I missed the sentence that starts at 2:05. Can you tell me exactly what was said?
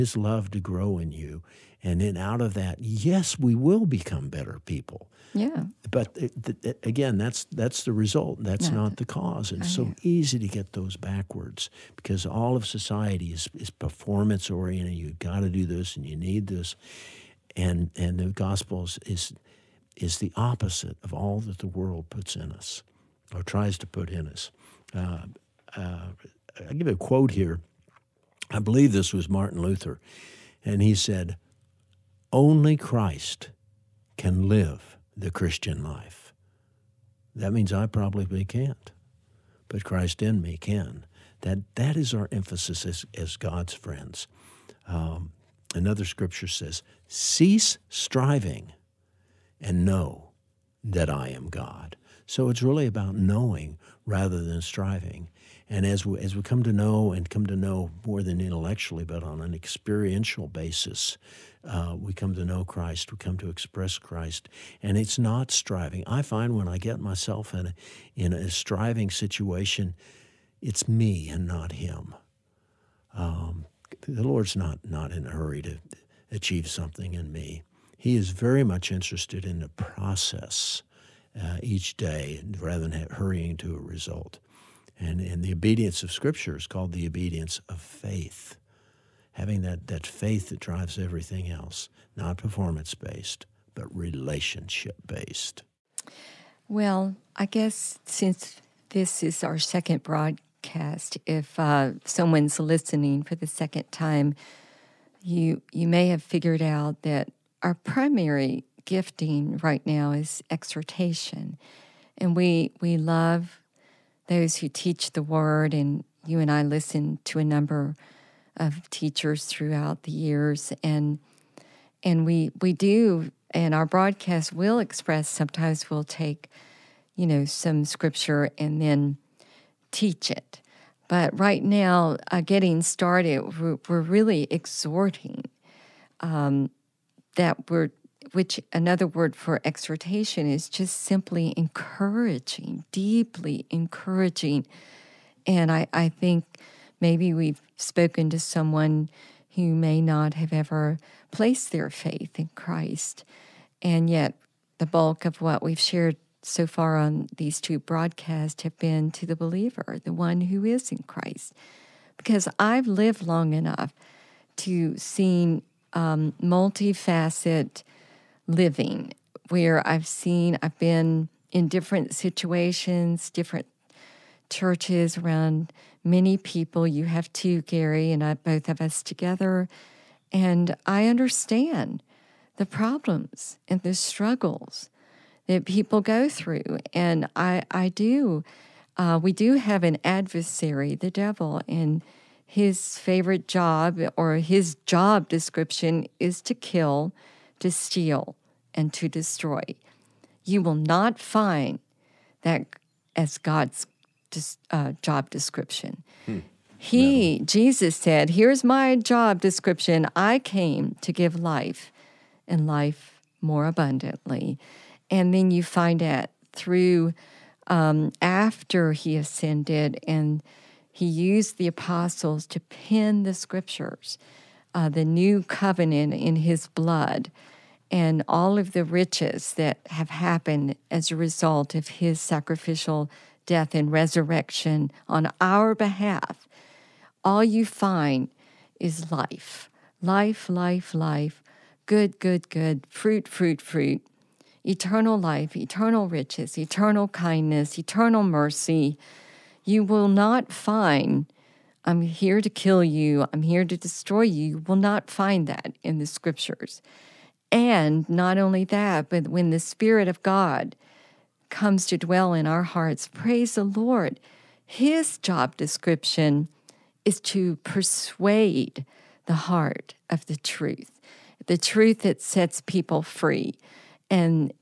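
Sometimes we'll take, you know, some scripture and then teach it.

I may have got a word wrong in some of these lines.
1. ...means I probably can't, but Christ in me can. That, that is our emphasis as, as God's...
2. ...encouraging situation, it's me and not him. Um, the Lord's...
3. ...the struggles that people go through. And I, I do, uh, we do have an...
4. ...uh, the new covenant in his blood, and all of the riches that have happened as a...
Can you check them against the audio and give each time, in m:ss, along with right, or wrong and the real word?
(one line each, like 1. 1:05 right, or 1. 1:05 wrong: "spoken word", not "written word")
1. 0:37 right
2. 1:08 wrong: "striving", not "encouraging"
3. 3:03 right
4. 3:44 right.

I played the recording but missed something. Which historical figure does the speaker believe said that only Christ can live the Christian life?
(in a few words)
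Martin Luther.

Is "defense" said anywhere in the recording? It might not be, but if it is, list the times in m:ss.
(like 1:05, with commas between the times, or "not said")
not said.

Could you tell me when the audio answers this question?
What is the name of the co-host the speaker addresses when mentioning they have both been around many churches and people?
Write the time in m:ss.
2:57.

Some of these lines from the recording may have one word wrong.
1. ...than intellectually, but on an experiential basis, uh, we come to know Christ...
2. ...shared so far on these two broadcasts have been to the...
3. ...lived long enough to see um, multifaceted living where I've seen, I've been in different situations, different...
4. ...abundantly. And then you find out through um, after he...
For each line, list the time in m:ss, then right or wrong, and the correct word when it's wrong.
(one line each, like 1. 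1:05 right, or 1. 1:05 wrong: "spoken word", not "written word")
1. 0:58 right
2. 2:35 right
3. 2:42 right
4. 3:33 right.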